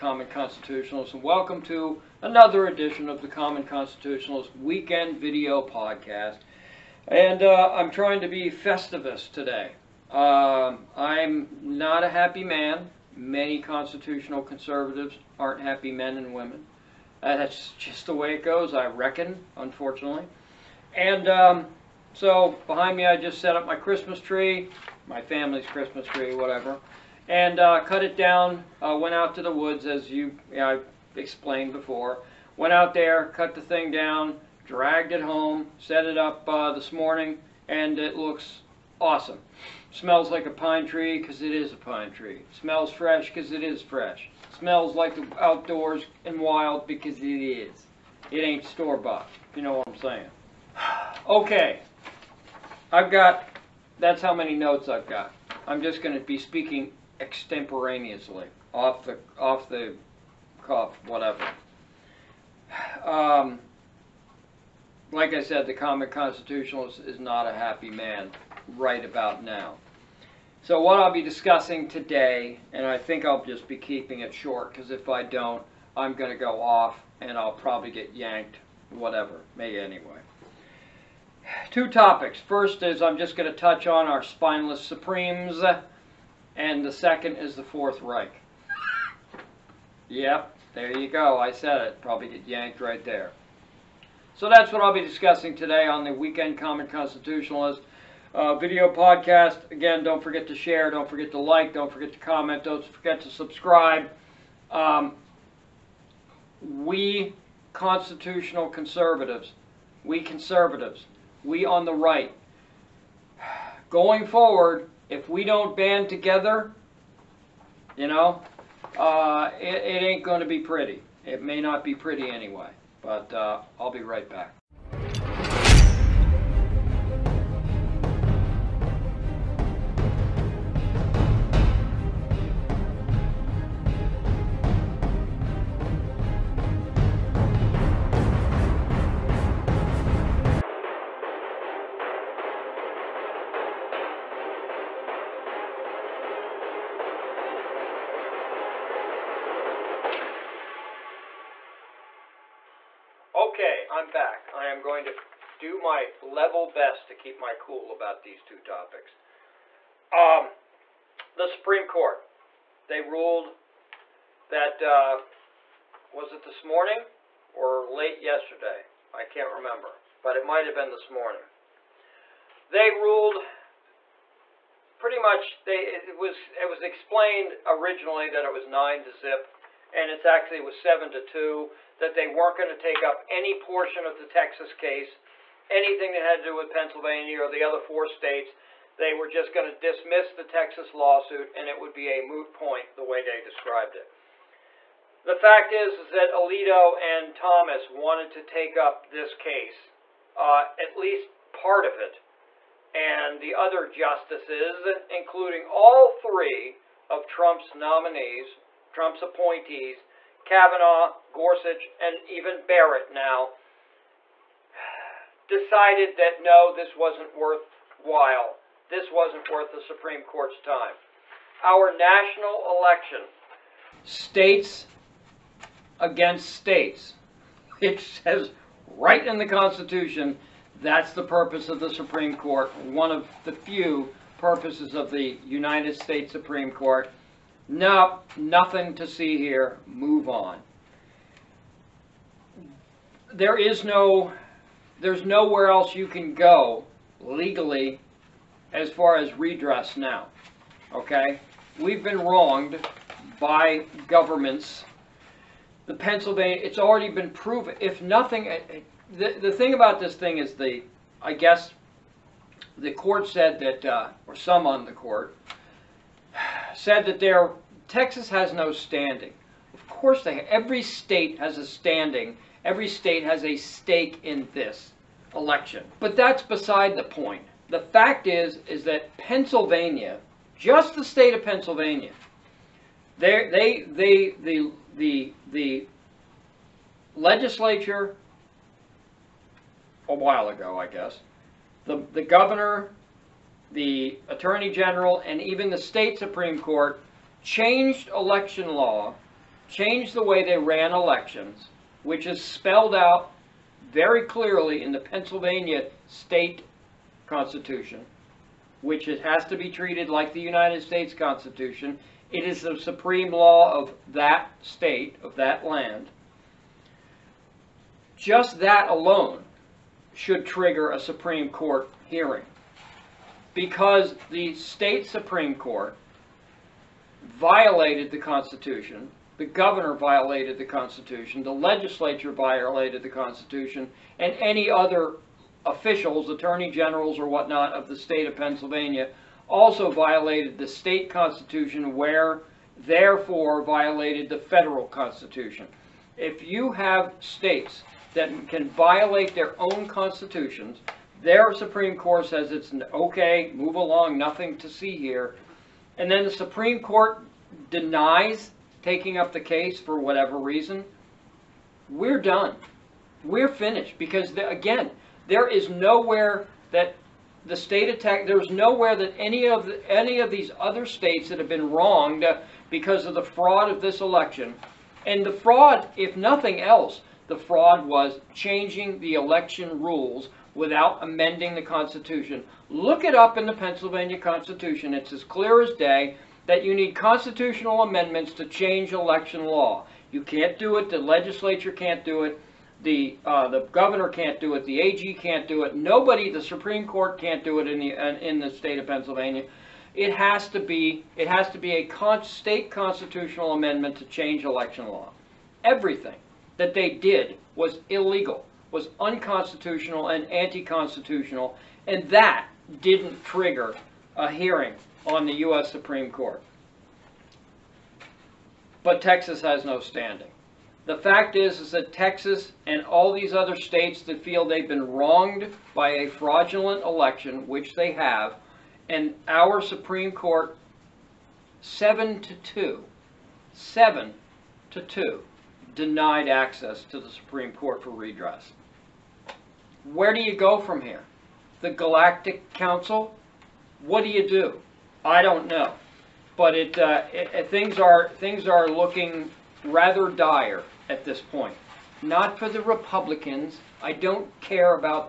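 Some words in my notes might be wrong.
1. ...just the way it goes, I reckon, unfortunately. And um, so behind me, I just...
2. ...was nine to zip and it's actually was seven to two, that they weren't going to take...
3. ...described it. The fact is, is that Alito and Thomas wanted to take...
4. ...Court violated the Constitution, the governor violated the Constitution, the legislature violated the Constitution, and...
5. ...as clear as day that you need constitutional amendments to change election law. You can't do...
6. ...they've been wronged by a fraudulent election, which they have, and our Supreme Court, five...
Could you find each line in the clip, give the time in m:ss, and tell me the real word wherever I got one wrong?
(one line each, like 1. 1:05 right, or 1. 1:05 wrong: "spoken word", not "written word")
1. 0:17 right
2. 2:58 right
3. 3:13 right
4. 5:25 right
5. 6:25 right
6. 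7:04 wrong: "seven", not "five".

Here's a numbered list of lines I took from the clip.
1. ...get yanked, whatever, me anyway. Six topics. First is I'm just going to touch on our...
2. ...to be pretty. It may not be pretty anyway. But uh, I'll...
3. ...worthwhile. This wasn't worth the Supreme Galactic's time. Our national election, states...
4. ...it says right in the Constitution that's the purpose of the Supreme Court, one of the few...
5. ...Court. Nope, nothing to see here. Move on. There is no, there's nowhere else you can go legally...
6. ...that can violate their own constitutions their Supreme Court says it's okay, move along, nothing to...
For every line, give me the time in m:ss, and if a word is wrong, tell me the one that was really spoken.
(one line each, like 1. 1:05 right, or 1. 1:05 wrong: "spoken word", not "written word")
1. 1:17 wrong: "Two", not "Six"
2. 2:00 right
3. 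3:37 wrong: "Court", not "Galactic"
4. 3:47 right
5. 3:56 right
6. 5:48 right.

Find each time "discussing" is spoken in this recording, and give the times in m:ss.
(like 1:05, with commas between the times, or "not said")
1:11, 1:35.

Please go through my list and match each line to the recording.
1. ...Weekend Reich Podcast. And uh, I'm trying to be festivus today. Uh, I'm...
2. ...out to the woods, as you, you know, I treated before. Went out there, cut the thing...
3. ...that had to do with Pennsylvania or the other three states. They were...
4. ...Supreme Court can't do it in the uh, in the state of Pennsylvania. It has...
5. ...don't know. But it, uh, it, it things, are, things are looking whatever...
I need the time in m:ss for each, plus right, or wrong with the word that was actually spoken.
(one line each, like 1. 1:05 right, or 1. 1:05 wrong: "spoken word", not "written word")
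1. 0:04 wrong: "Video", not "Reich"
2. 0:29 wrong: "explained", not "treated"
3. 3:06 wrong: "four", not "three"
4. 6:36 right
5. 7:25 wrong: "rather", not "whatever".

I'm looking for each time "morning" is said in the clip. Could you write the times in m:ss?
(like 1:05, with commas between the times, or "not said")
0:36, 2:46, 2:51.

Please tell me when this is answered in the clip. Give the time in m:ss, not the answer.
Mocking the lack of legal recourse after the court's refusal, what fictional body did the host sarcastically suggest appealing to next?
7:21.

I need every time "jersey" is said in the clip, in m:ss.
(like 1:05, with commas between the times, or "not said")
not said.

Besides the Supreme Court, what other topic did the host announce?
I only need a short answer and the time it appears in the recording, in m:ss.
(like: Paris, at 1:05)
The Fourth Reich, at 1:27.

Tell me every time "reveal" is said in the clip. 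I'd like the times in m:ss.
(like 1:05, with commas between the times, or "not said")
not said.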